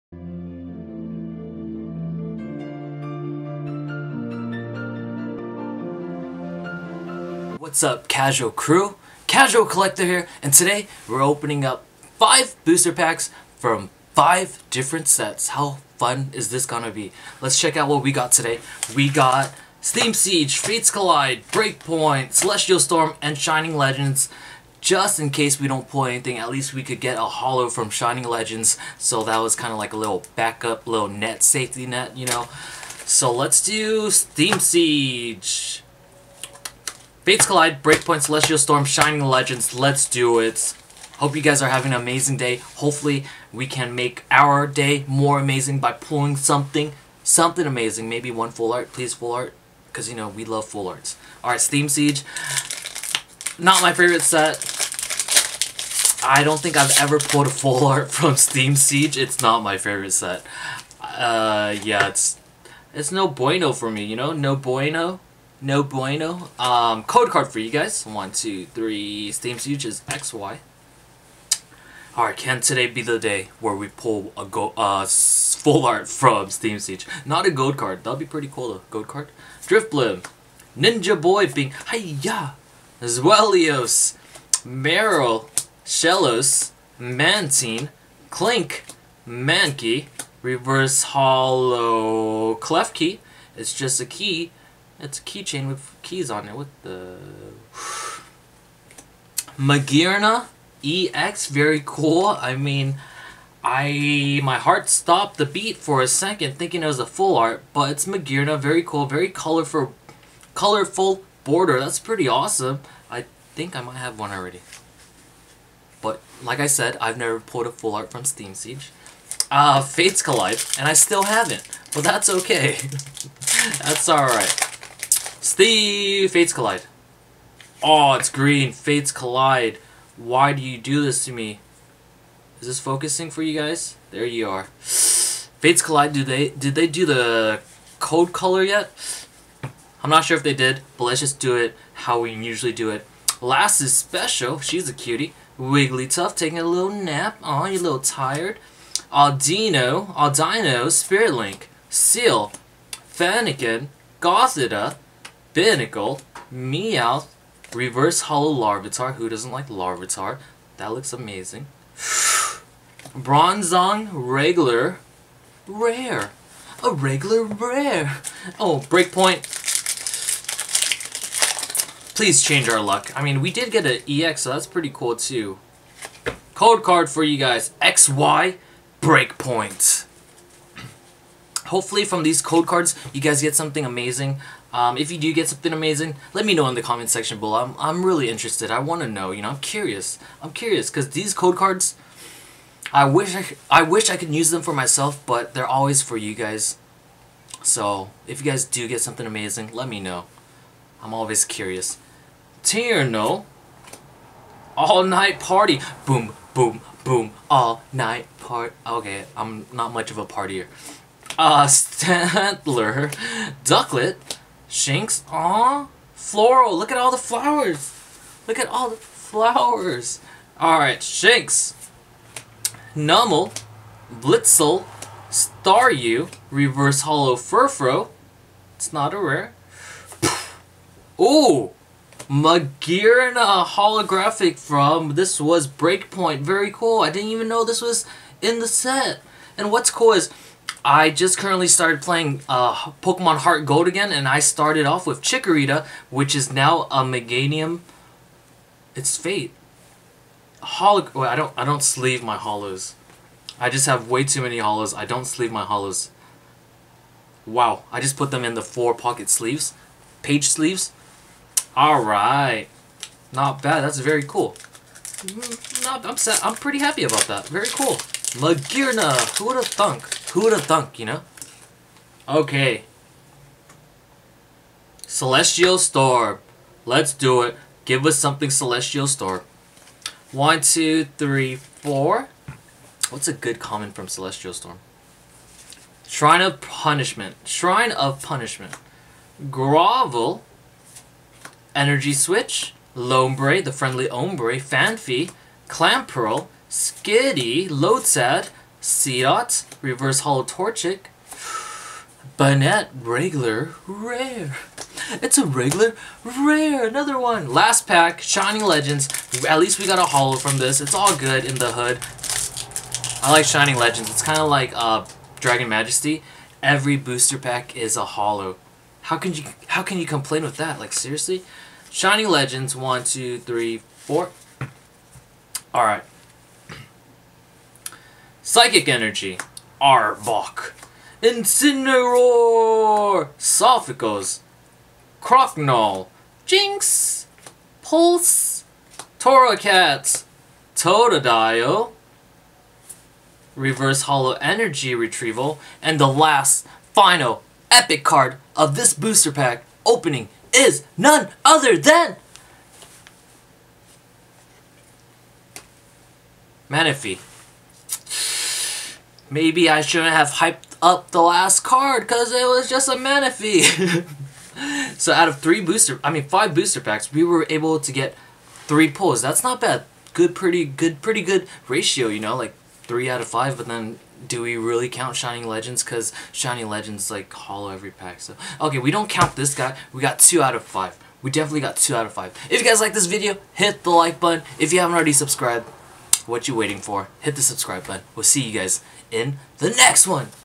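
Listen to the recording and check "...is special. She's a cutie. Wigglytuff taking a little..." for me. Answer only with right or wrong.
right.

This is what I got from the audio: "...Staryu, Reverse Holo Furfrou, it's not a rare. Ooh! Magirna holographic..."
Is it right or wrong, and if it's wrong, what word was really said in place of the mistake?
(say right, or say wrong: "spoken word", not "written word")
right.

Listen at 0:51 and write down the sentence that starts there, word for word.
Alright, Steam Siege, not my favorite set.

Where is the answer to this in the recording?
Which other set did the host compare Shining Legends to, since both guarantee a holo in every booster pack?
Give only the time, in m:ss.
5:15.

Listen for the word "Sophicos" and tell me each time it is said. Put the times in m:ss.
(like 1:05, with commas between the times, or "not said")
5:33.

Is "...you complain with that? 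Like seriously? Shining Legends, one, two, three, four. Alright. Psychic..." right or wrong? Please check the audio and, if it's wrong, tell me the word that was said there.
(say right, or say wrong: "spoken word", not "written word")
right.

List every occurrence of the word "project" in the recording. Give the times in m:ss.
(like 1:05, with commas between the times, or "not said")
not said.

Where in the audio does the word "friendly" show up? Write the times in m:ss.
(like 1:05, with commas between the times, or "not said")
4:53.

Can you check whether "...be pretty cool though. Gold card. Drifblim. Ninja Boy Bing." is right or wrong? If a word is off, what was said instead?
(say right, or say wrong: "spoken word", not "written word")
right.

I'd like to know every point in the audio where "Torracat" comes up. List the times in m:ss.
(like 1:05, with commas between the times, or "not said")
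5:39.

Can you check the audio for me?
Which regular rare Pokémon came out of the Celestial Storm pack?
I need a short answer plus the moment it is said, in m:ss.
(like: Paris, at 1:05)
Banette, at 5:02.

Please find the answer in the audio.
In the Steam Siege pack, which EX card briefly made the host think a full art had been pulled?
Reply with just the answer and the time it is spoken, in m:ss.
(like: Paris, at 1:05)
Magearna EX, at 1:39.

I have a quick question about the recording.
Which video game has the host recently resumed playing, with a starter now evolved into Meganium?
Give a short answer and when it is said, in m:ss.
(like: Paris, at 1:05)
Pokemon HeartGold, at 4:03.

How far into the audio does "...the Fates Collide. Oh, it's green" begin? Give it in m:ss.
2:05.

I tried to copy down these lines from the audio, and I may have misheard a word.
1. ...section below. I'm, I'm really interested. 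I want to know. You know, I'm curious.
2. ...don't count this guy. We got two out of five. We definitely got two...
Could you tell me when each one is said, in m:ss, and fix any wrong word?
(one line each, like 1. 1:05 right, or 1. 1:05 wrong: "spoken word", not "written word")
1. 3:07 right
2. 6:18 right.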